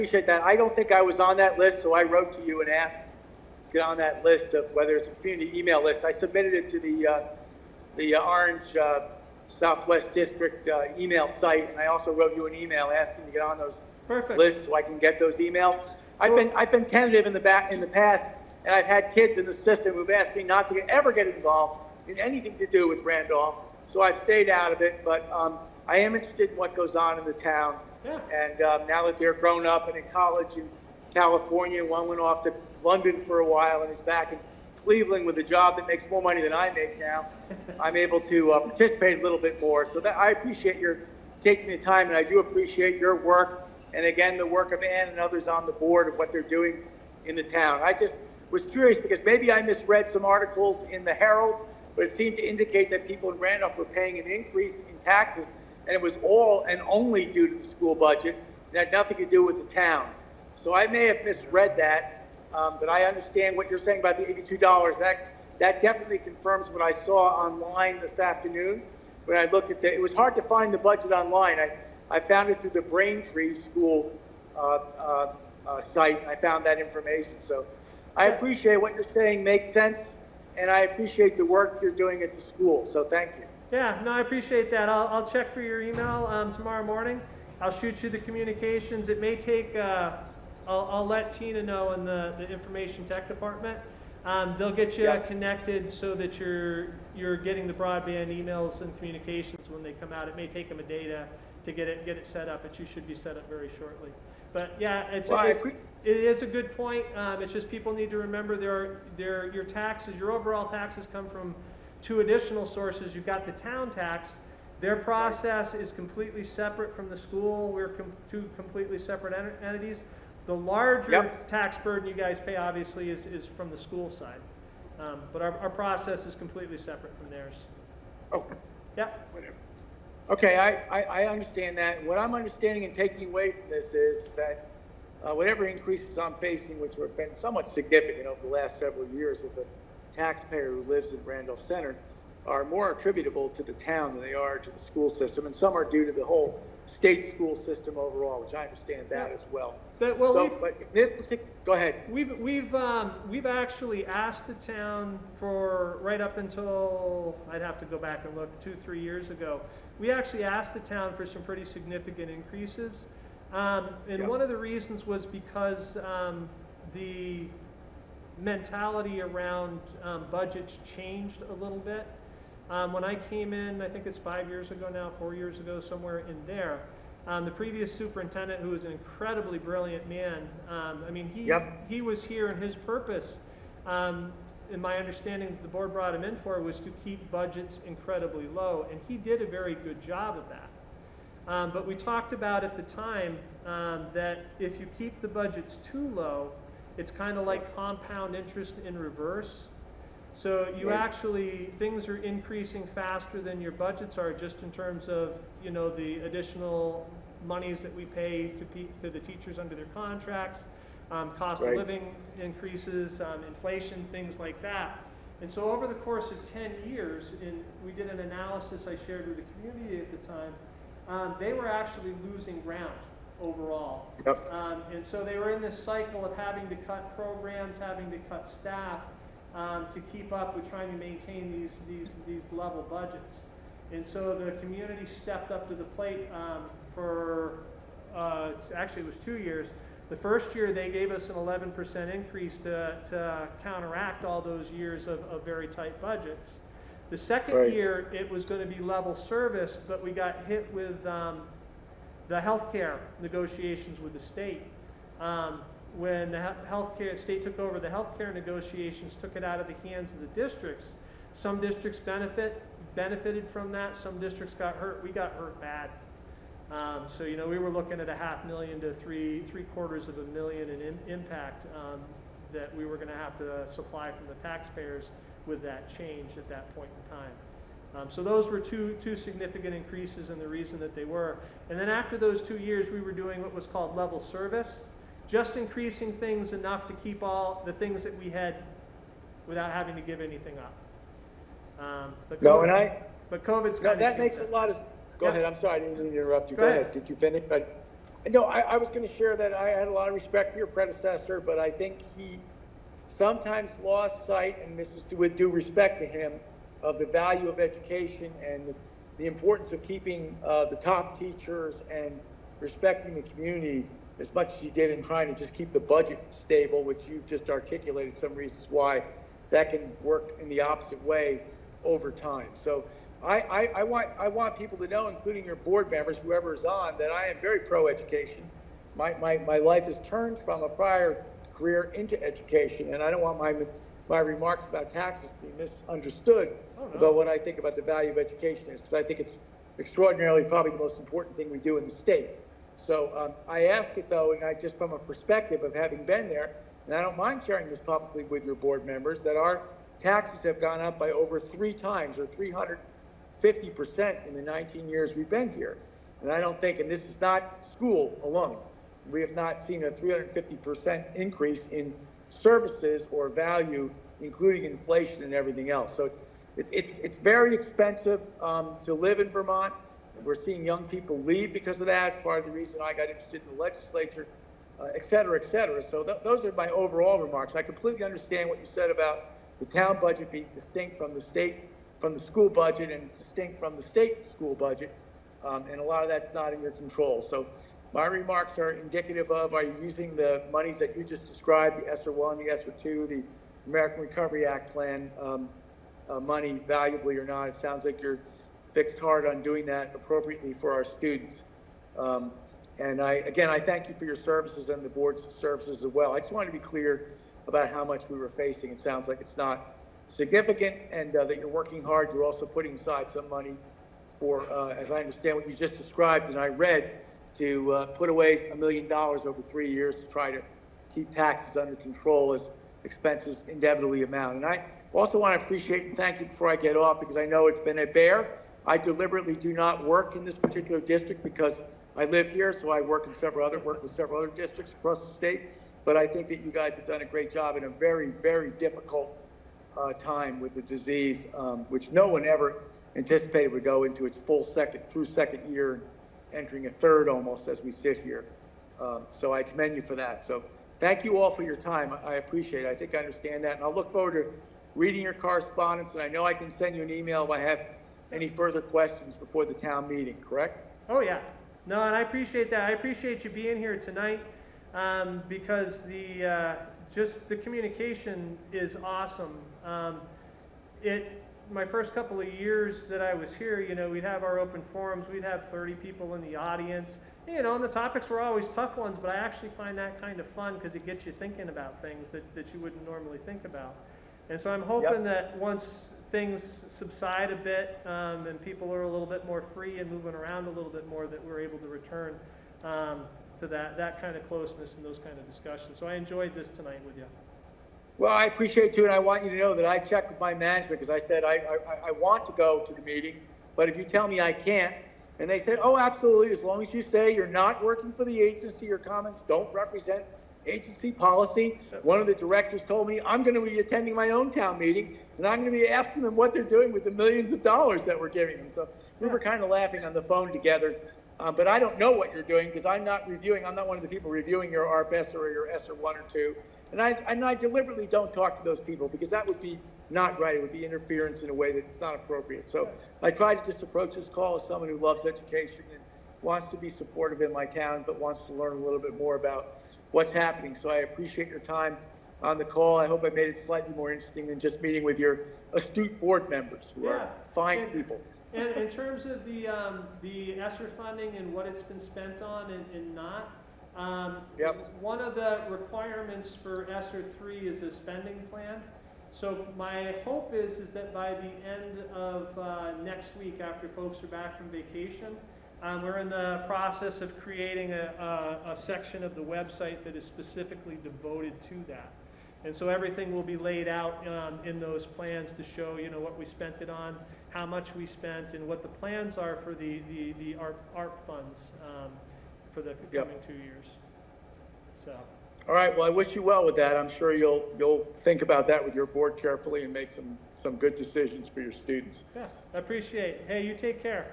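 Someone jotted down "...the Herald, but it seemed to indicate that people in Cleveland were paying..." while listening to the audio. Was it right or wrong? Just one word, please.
wrong.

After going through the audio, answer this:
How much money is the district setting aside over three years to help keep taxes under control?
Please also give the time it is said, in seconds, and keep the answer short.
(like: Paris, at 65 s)
a million dollars, at 418 s.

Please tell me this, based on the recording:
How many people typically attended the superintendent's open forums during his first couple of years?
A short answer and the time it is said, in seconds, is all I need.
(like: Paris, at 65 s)
30, at 475 s.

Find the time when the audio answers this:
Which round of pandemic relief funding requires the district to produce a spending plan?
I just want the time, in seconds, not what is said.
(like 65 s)
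556 s.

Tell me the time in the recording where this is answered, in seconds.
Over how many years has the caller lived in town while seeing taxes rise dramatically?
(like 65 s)
354 s.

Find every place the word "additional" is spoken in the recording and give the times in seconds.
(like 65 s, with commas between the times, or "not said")
112 s, 206 s.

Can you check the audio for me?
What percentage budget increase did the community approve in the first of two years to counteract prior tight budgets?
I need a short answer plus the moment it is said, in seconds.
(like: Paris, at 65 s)
11%, at 241 s.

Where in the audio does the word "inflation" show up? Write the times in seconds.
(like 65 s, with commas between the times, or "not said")
213 s, 364 s.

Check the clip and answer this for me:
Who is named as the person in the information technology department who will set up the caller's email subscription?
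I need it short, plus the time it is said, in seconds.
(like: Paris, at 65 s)
Tina, at 91 s.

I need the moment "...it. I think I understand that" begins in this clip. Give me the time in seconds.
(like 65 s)
452 s.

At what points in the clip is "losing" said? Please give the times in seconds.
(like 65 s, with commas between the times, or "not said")
222 s.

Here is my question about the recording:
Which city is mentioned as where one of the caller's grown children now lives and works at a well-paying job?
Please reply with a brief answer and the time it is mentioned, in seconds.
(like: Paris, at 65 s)
Cleveland, at 34 s.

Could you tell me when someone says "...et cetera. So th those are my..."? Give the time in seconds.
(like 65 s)
375 s.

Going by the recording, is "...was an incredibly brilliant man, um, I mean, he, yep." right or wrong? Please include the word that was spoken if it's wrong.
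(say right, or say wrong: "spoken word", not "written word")
right.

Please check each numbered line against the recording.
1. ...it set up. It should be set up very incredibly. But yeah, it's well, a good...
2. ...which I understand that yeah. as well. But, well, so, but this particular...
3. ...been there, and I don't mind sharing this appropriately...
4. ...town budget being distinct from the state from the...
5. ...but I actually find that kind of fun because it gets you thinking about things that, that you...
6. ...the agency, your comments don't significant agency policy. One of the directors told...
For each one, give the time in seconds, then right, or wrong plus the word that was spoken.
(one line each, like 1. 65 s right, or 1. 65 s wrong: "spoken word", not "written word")
1. 102 s wrong: "shortly", not "incredibly"
2. 148 s right
3. 346 s wrong: "publicly", not "appropriately"
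4. 379 s right
5. 478 s right
6. 508 s wrong: "represent", not "significant".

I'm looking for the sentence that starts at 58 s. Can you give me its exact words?
It had nothing to do with the town.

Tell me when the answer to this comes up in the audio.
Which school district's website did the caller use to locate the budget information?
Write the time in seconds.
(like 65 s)
72 s.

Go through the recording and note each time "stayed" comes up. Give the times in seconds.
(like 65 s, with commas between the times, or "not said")
24 s.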